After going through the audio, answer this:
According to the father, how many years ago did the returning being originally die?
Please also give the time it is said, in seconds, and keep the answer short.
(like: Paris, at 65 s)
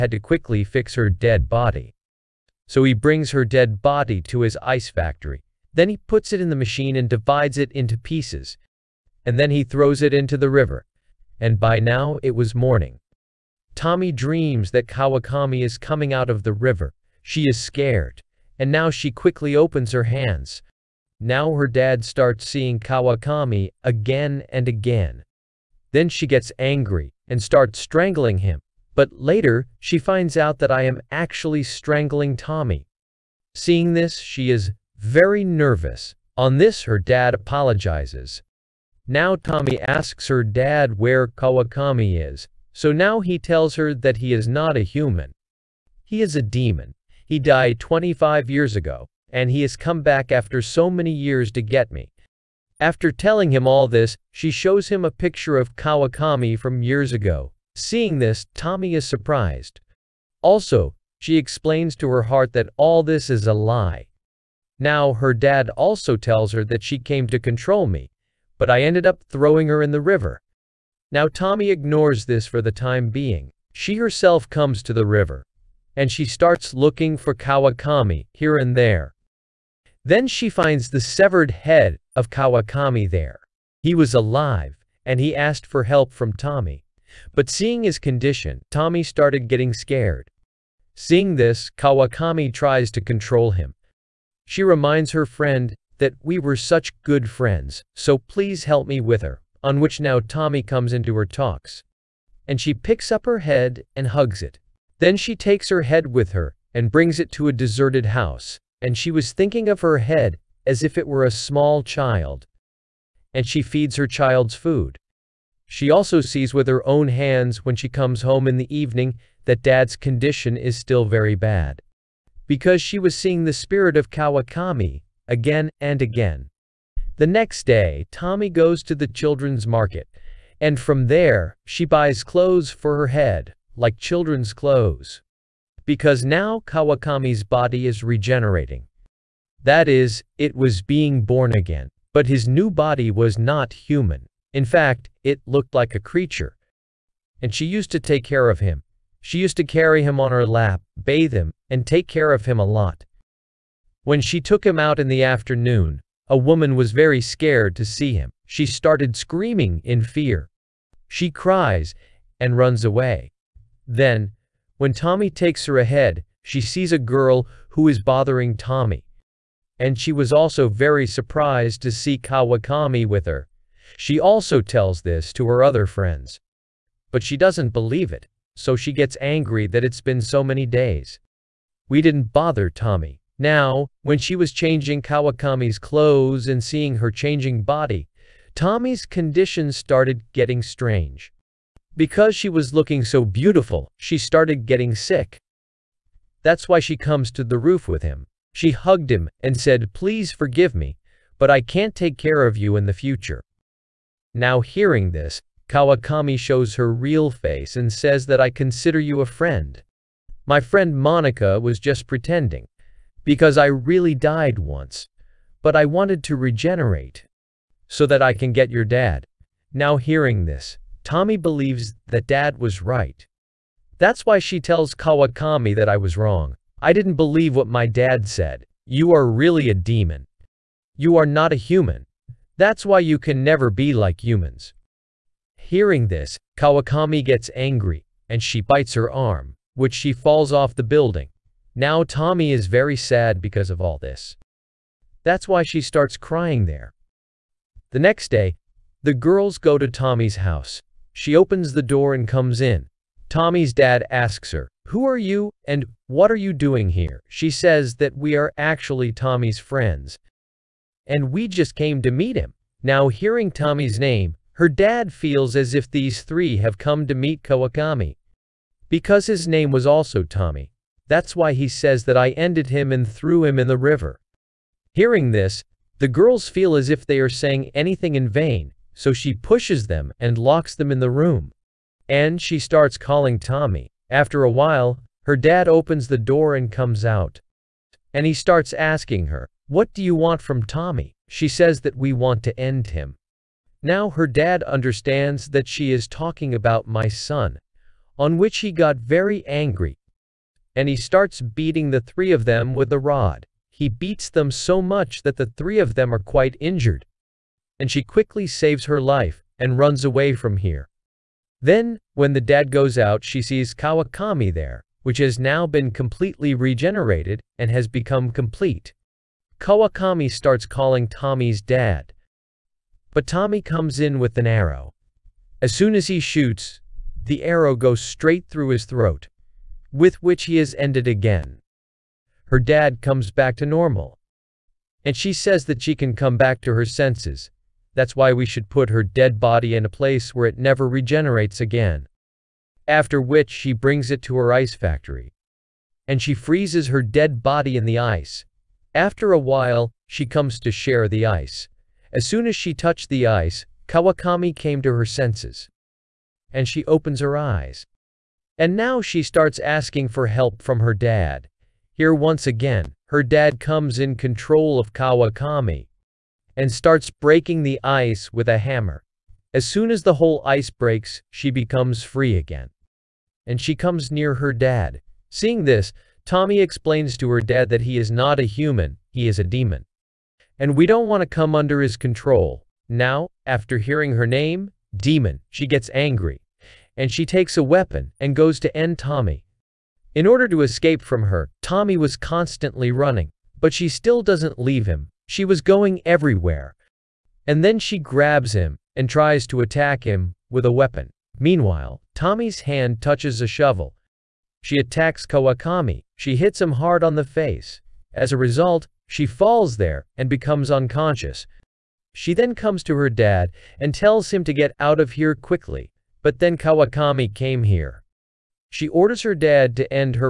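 25, at 47 s.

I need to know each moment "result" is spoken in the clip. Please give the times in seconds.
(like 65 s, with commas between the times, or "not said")
408 s.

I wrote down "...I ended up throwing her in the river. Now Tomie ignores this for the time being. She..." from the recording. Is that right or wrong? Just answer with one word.
right.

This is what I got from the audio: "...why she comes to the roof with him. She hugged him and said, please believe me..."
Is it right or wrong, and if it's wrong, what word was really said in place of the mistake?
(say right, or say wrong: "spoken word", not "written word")
wrong: "forgive", not "believe".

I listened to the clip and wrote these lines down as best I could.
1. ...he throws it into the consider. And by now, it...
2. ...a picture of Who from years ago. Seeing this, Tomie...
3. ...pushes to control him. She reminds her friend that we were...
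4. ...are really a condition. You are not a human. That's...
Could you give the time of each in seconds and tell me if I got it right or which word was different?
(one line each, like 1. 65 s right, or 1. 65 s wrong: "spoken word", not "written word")
1. 9 s wrong: "river", not "consider"
2. 55 s wrong: "Kawakami", not "Who"
3. 92 s wrong: "tries", not "pushes"
4. 229 s wrong: "demon", not "condition".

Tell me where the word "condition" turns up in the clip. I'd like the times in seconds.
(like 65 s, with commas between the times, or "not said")
87 s, 119 s, 189 s.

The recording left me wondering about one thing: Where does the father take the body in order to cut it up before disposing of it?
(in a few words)
His ice factory.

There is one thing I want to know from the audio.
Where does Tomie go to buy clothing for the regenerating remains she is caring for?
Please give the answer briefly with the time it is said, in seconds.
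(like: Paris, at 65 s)
Children's market, at 129 s.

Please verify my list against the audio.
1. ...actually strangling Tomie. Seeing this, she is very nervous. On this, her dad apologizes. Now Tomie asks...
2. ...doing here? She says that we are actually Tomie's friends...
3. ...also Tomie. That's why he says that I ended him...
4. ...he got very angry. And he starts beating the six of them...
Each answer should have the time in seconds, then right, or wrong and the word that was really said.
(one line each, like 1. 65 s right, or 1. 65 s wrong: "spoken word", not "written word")
1. 31 s right
2. 256 s right
3. 269 s right
4. 298 s wrong: "three", not "six".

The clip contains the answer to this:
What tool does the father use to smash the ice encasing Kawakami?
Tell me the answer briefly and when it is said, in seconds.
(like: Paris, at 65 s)
A hammer, at 368 s.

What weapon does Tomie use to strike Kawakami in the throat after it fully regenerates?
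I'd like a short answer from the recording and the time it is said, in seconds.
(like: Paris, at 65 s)
An arrow, at 324 s.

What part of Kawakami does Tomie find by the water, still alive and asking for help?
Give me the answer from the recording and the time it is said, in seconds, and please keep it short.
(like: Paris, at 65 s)
Severed head, at 80 s.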